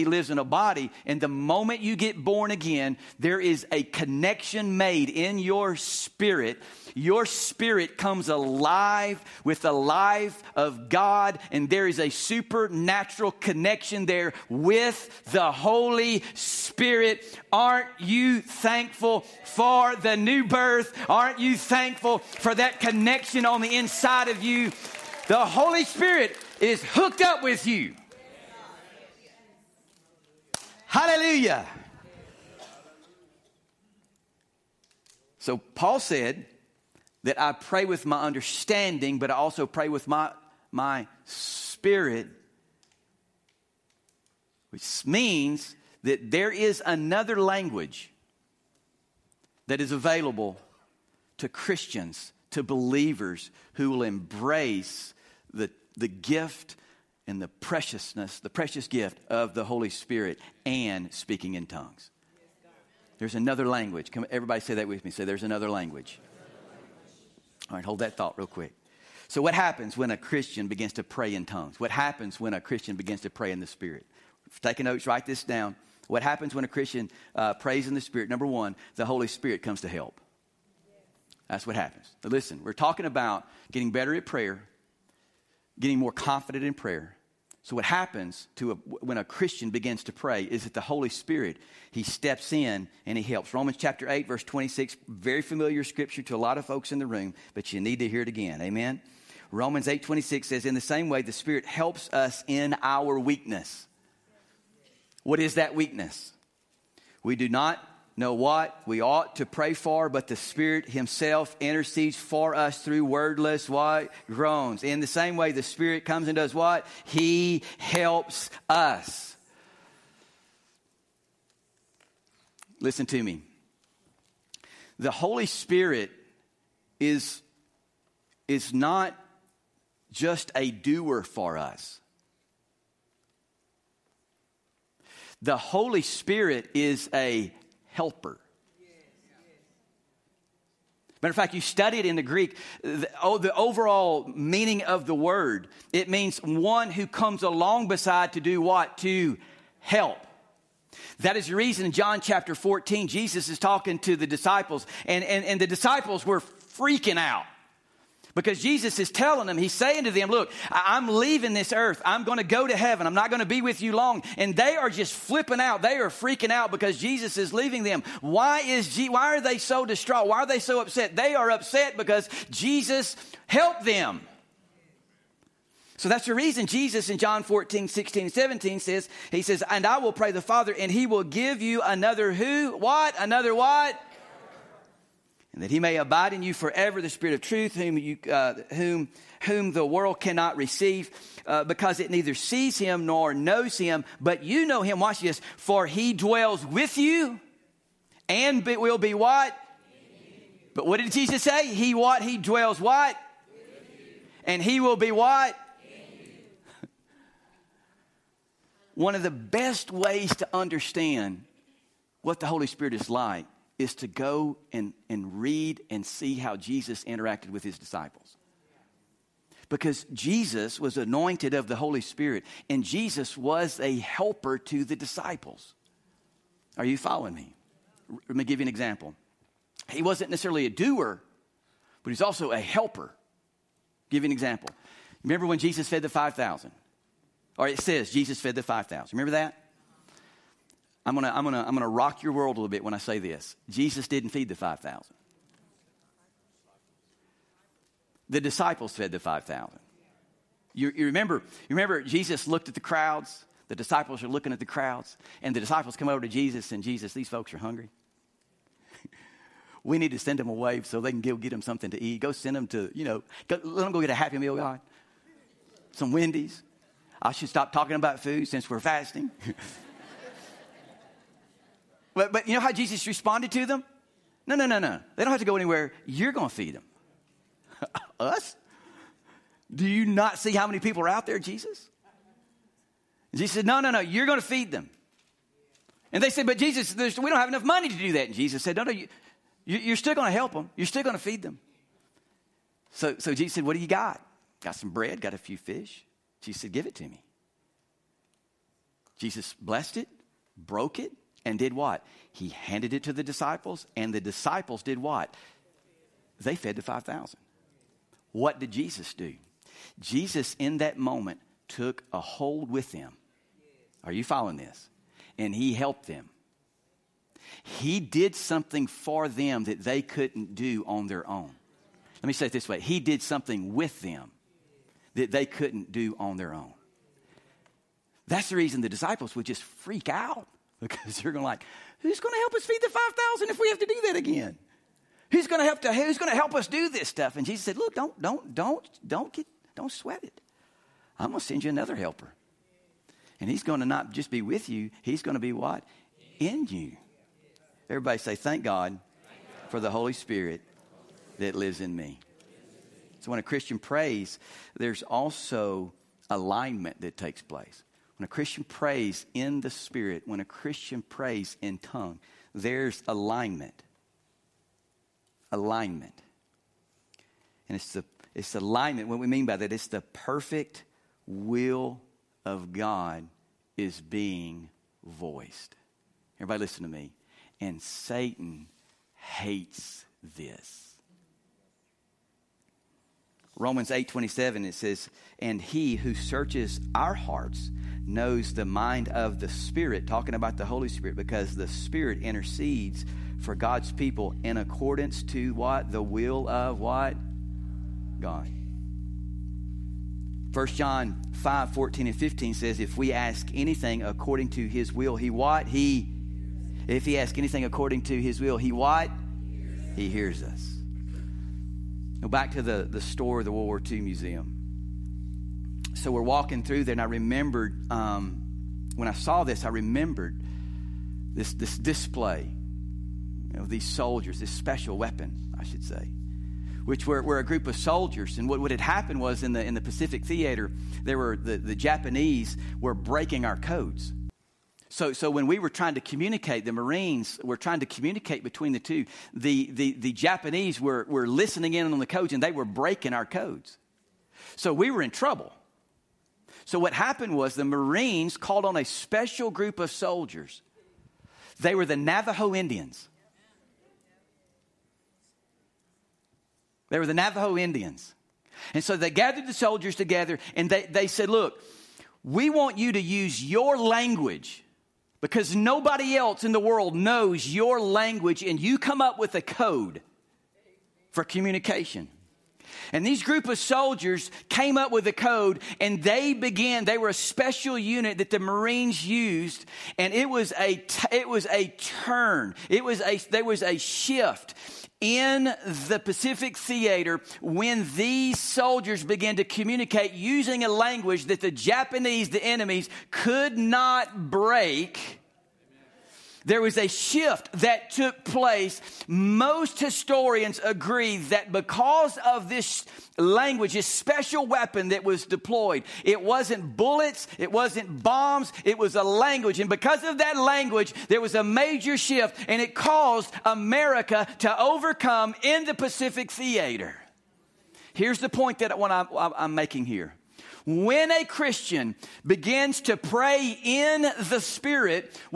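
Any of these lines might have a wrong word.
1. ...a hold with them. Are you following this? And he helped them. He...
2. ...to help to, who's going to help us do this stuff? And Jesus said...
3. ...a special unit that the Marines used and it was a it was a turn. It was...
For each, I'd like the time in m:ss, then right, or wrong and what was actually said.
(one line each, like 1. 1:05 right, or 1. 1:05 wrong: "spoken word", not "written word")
1. 5:12 right
2. 5:35 right
3. 7:57 right.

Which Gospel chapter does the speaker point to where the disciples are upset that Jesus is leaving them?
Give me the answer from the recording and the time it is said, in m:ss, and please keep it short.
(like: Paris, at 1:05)
John 14, at 2:31.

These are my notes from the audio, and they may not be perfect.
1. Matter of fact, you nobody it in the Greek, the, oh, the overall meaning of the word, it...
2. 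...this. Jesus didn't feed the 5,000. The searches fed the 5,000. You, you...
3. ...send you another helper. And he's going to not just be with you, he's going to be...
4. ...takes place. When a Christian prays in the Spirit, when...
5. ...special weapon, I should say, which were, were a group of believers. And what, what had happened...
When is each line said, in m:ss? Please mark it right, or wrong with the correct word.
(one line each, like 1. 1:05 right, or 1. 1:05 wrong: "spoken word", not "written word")
1. 2:21 wrong: "study", not "nobody"
2. 4:03 wrong: "disciples", not "searches"
3. 5:41 right
4. 5:57 right
5. 7:04 wrong: "soldiers", not "believers".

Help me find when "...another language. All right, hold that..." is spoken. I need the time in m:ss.
1:05.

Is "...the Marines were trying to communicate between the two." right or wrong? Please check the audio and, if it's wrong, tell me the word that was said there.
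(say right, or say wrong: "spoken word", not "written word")
right.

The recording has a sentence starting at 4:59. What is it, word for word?
Jesus blessed it, broke it, and did what?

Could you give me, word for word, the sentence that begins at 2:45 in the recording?
They are freaking out because Jesus is leaving them.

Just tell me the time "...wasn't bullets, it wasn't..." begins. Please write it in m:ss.
8:26.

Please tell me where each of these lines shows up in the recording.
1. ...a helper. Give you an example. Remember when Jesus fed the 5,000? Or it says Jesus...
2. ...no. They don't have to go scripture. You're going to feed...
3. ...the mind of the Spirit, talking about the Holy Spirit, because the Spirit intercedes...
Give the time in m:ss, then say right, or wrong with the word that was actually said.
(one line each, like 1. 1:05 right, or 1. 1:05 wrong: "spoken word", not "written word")
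1. 3:52 right
2. 4:34 wrong: "anywhere", not "scripture"
3. 6:28 right.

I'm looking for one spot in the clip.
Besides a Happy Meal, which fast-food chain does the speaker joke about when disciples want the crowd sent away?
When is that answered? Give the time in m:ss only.
4:25.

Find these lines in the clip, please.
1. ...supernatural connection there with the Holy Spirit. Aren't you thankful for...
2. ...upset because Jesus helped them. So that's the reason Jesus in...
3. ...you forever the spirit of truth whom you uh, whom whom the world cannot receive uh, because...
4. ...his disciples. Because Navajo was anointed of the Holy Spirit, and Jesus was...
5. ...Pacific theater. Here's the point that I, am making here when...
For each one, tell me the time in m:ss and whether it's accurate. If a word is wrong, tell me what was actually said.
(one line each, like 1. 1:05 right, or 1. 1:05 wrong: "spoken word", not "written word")
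1. 0:12 right
2. 2:51 right
3. 3:06 right
4. 3:37 wrong: "Jesus", not "Navajo"
5. 8:35 right.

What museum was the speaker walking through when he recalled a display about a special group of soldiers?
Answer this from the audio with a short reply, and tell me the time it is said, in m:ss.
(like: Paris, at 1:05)
World War II Museum, at 6:53.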